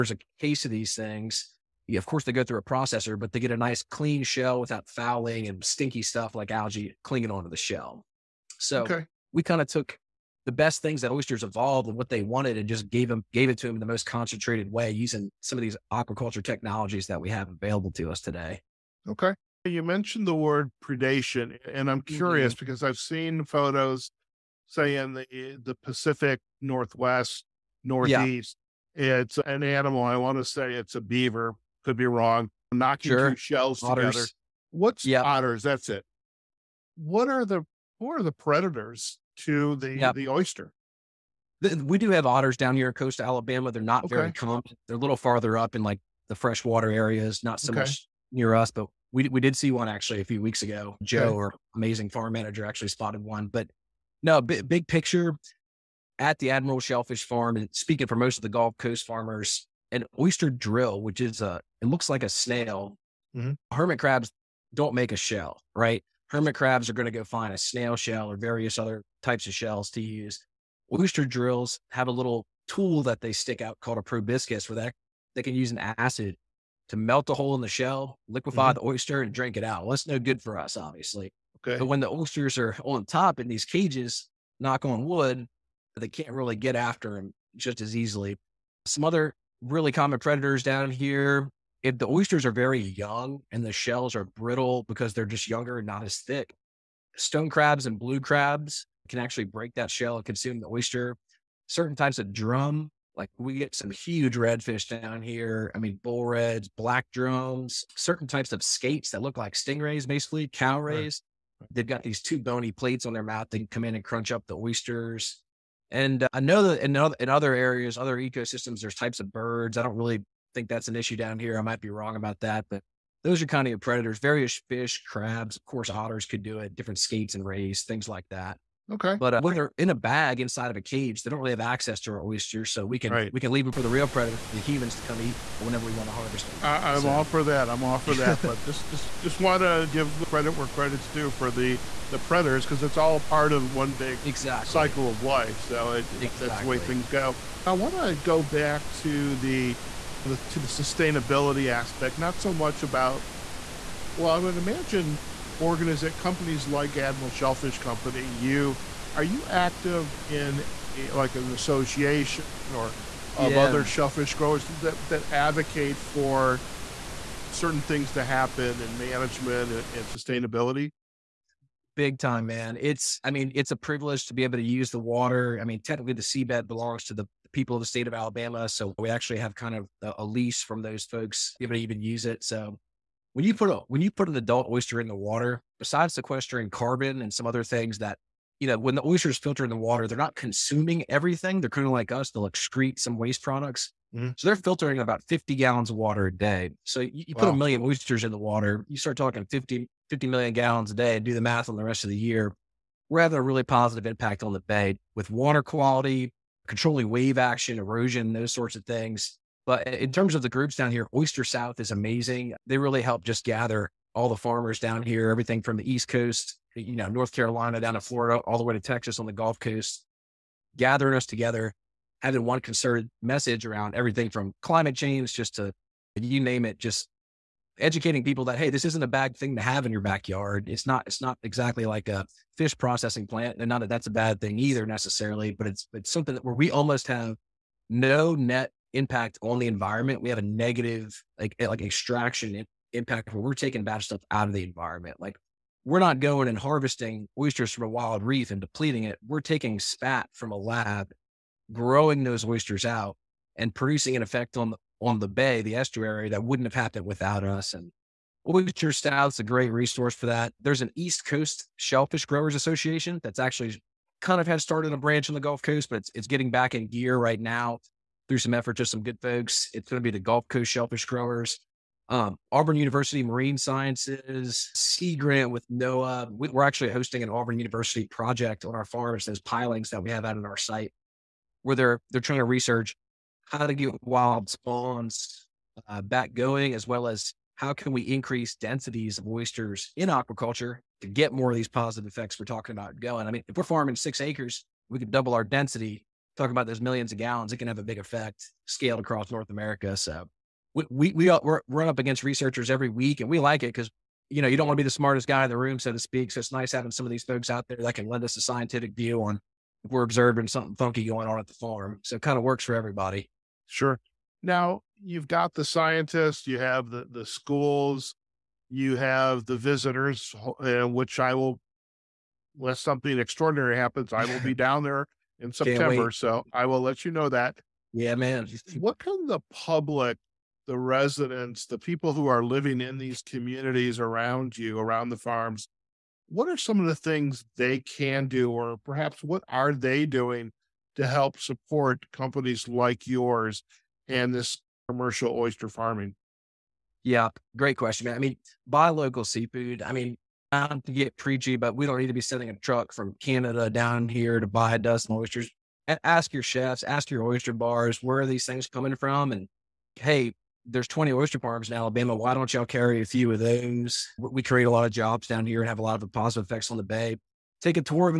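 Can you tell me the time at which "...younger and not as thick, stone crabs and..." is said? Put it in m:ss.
1:35.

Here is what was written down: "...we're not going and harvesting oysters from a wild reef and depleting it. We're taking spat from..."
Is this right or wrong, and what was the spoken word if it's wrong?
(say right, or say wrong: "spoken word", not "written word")
right.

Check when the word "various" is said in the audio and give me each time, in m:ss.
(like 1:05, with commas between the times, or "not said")
1:08, 2:04.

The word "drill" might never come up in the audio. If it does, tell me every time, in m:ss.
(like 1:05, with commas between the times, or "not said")
1:00, 1:11.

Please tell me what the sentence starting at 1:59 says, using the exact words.
I don't really think that's an issue down here.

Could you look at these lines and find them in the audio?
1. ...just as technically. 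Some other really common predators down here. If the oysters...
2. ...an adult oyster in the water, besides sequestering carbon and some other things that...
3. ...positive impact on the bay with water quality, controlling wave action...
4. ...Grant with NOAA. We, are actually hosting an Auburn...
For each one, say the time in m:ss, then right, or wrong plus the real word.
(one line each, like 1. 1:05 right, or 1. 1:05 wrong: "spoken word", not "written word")
1. 1:27 wrong: "easily", not "technically"
2. 3:04 right
3. 3:23 right
4. 4:35 right.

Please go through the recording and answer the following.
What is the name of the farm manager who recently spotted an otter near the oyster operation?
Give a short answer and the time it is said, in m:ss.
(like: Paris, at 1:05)
Joe, at 0:51.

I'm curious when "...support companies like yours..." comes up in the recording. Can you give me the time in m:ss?
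5:41.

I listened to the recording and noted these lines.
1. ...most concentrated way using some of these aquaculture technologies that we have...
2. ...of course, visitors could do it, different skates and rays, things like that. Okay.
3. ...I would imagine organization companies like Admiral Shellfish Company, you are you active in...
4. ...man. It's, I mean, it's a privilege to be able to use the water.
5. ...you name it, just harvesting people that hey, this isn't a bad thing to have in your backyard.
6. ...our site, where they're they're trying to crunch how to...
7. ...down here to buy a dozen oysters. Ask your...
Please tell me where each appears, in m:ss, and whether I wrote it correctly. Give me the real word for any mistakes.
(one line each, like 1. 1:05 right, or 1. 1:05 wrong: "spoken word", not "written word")
1. 0:13 right
2. 2:05 wrong: "otters", not "visitors"
3. 2:34 right
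4. 2:52 right
5. 3:46 wrong: "educating", not "harvesting"
6. 4:40 wrong: "research", not "crunch"
7. 5:53 right.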